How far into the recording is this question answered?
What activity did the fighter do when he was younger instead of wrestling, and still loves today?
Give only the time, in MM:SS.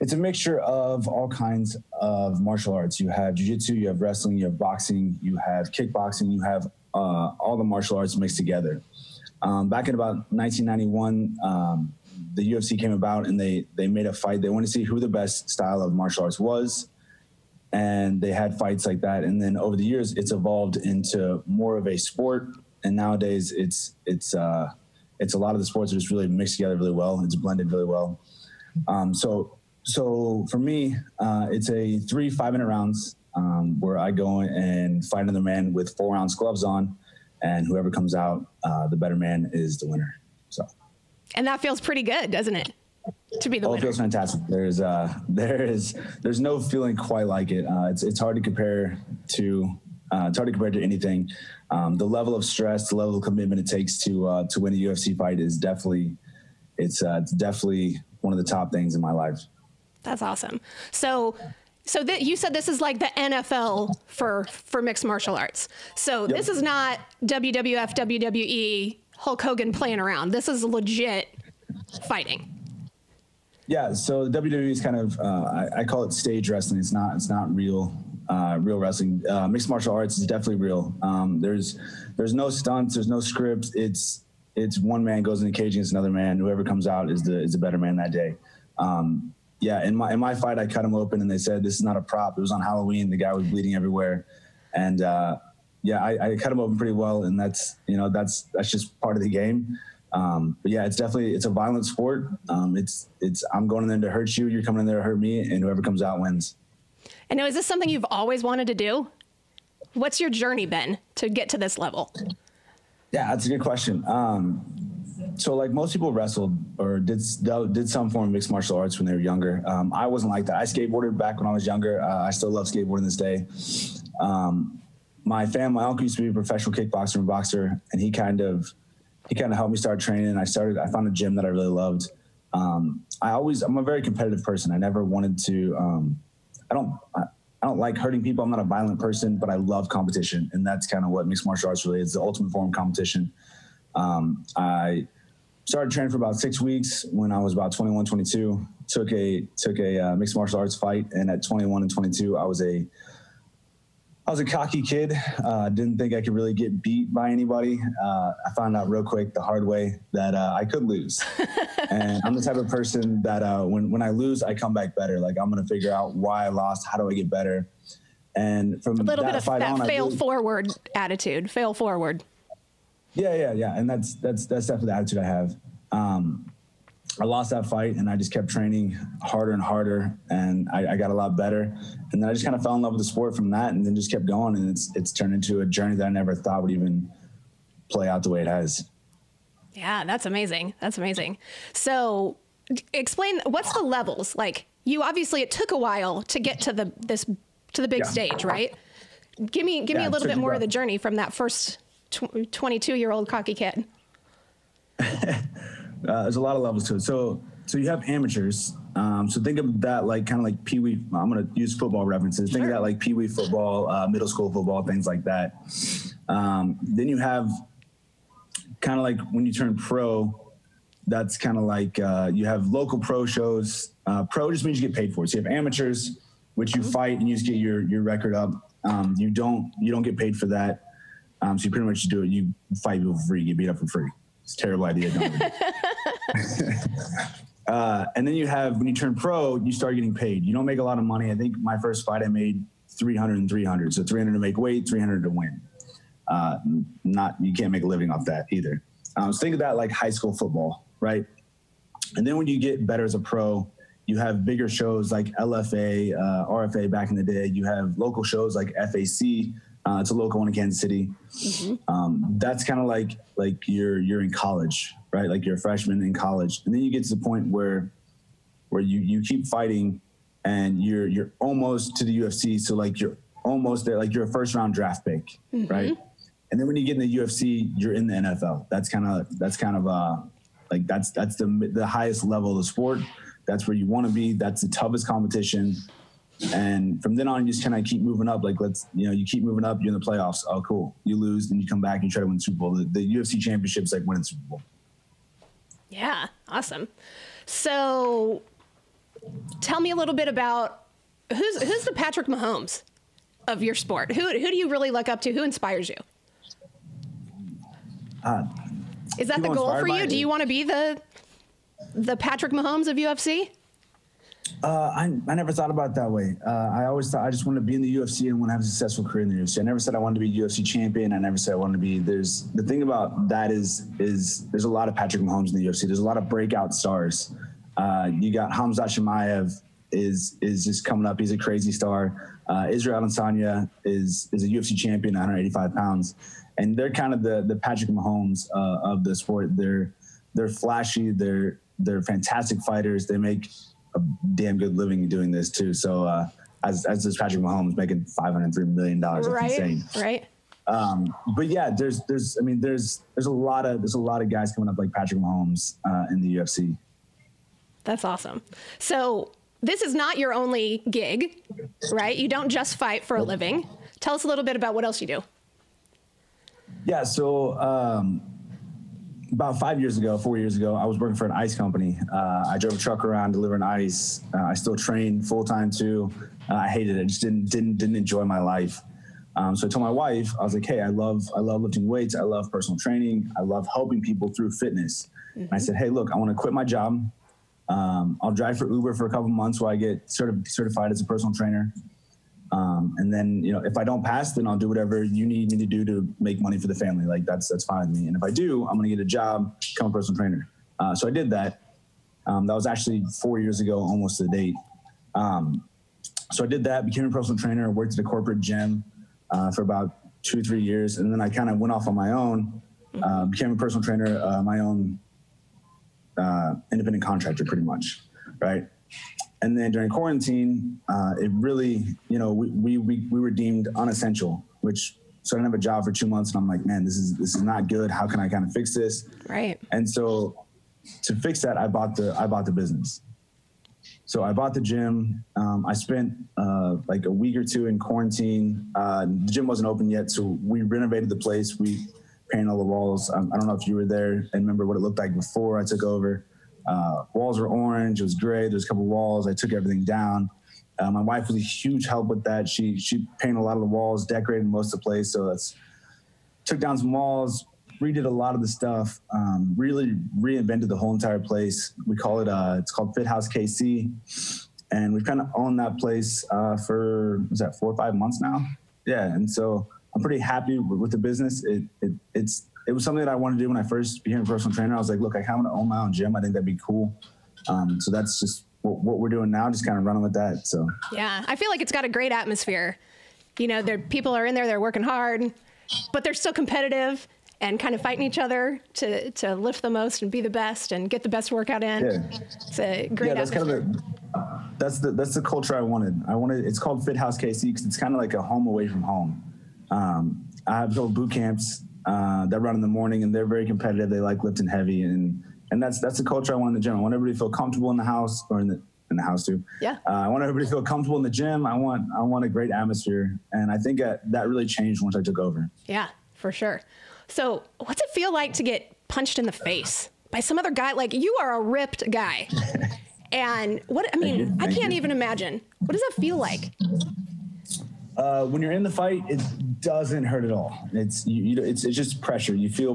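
02:00.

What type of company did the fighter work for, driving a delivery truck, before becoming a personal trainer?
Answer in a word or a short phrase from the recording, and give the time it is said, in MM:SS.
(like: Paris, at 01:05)
An ice company, at 06:11.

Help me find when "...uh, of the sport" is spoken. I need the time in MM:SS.
05:38.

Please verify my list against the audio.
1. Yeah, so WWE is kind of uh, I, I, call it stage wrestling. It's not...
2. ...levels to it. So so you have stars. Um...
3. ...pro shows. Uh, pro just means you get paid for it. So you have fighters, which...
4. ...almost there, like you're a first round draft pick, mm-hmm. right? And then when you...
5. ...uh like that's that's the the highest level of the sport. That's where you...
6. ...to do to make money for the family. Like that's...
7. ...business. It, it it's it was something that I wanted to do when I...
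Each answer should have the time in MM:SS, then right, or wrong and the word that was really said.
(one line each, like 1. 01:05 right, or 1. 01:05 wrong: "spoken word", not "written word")
1. 01:13 right
2. 03:26 wrong: "amateurs", not "stars"
3. 03:42 wrong: "amateurs", not "fighters"
4. 04:33 right
5. 04:39 right
6. 06:35 right
7. 07:50 right.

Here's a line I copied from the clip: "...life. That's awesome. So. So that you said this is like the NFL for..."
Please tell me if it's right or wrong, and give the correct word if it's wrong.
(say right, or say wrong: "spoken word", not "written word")
right.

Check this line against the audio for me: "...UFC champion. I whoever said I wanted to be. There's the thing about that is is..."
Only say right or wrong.
wrong.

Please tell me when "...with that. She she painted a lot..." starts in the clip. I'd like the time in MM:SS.
07:32.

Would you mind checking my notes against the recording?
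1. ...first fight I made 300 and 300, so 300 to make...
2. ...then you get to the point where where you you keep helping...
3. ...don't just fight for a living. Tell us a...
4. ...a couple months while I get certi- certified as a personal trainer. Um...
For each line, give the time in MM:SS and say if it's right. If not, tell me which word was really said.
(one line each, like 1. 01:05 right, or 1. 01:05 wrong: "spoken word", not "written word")
1. 04:01 right
2. 04:26 wrong: "fighting", not "helping"
3. 06:02 right
4. 06:29 right.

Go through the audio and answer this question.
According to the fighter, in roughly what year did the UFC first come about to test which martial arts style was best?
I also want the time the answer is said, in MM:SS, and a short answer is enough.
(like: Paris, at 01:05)
1991, at 00:10.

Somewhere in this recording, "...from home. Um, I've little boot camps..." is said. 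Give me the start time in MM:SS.
08:18.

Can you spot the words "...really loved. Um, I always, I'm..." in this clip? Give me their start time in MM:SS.
02:11.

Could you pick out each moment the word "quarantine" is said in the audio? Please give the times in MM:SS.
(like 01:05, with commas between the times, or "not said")
06:59, 07:17.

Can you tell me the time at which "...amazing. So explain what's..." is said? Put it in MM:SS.
03:10.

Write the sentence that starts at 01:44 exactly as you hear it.
You're coming in there to hurt me, and whoever comes out wins.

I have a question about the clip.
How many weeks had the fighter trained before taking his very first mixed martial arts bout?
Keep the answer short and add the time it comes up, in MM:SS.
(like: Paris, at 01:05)
6 weeks, at 02:26.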